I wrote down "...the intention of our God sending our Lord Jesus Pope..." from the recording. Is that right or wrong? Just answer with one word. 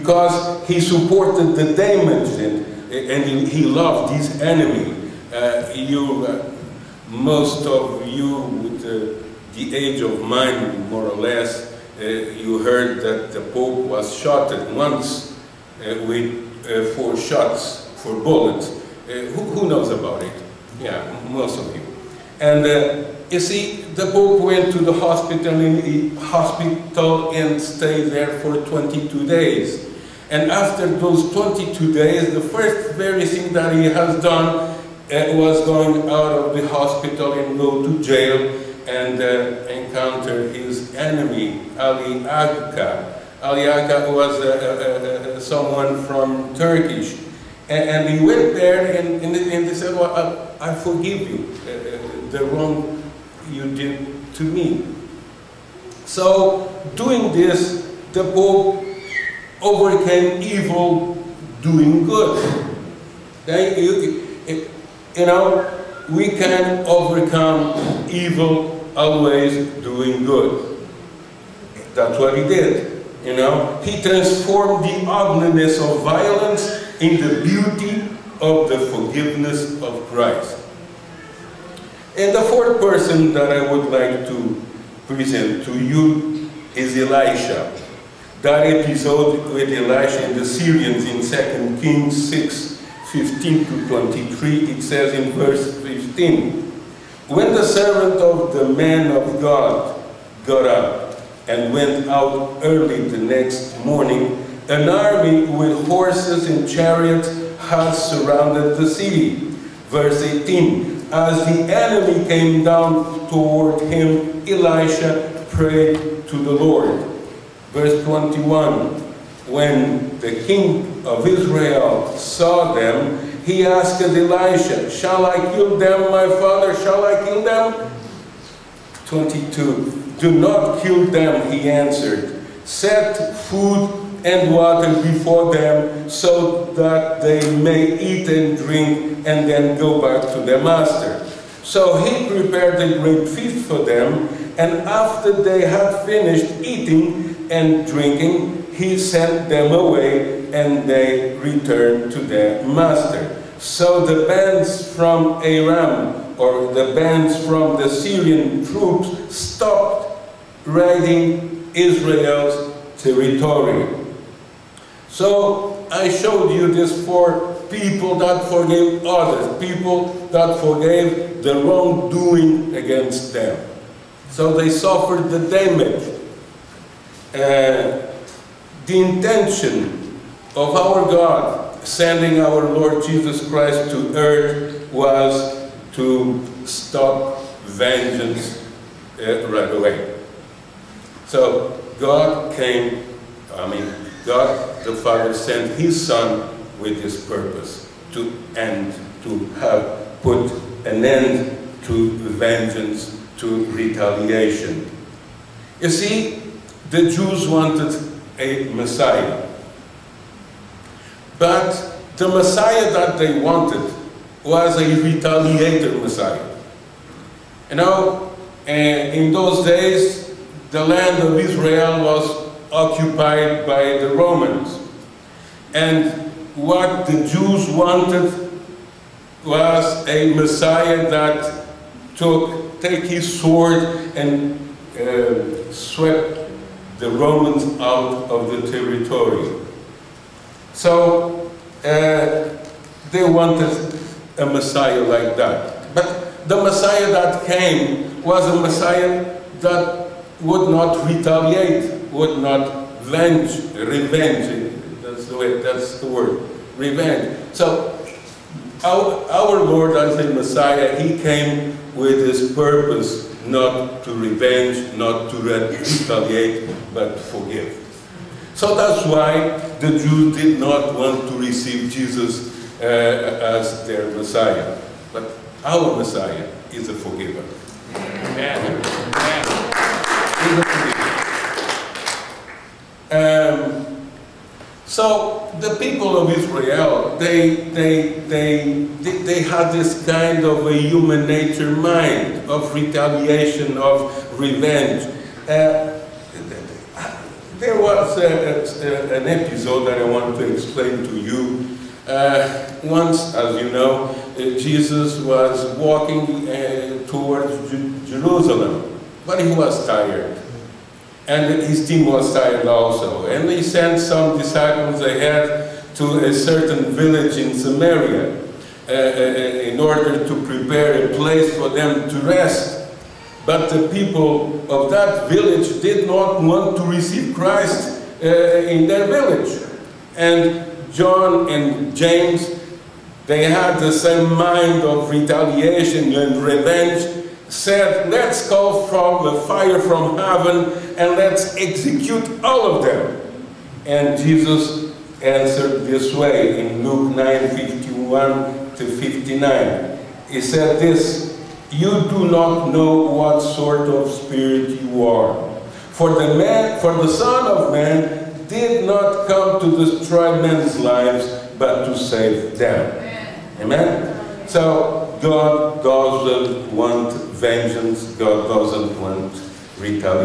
wrong.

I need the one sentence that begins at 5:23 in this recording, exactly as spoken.
But the people of that village did not want to receive Christ uh, in their village.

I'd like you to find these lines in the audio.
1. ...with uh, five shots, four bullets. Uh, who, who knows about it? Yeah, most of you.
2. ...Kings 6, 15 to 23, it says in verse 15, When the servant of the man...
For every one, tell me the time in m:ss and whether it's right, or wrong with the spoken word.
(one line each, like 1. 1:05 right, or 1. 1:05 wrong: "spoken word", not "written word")
1. 0:16 wrong: "four", not "five"
2. 1:31 right.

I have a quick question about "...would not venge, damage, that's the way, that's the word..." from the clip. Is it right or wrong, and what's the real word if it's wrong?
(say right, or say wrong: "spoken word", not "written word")
wrong: "revenge", not "damage".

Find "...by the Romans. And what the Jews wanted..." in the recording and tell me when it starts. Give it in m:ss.
3:43.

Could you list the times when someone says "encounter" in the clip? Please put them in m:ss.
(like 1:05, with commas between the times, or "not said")
0:39.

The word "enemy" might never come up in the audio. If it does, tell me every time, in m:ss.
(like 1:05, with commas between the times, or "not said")
0:04, 0:40, 1:51.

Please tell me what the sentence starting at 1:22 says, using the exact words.
And the fourth person that I would like to present to you is Elisha.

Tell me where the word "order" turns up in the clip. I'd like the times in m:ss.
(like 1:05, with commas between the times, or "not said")
5:19.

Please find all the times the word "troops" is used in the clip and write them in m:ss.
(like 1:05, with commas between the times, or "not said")
2:38.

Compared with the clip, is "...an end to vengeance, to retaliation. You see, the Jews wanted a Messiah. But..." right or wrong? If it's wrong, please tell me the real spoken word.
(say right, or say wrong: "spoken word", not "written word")
right.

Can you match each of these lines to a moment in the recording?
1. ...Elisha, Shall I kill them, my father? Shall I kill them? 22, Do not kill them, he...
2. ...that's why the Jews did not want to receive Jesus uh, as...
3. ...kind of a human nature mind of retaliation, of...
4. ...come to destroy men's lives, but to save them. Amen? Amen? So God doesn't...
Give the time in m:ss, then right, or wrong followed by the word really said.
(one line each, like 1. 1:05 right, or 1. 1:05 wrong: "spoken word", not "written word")
1. 2:04 right
2. 4:28 right
3. 4:50 right
4. 5:59 right.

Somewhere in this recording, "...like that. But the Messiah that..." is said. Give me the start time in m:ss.
4:05.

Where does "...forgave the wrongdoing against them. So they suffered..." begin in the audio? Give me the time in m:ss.
2:50.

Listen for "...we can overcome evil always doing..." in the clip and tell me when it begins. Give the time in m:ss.
1:06.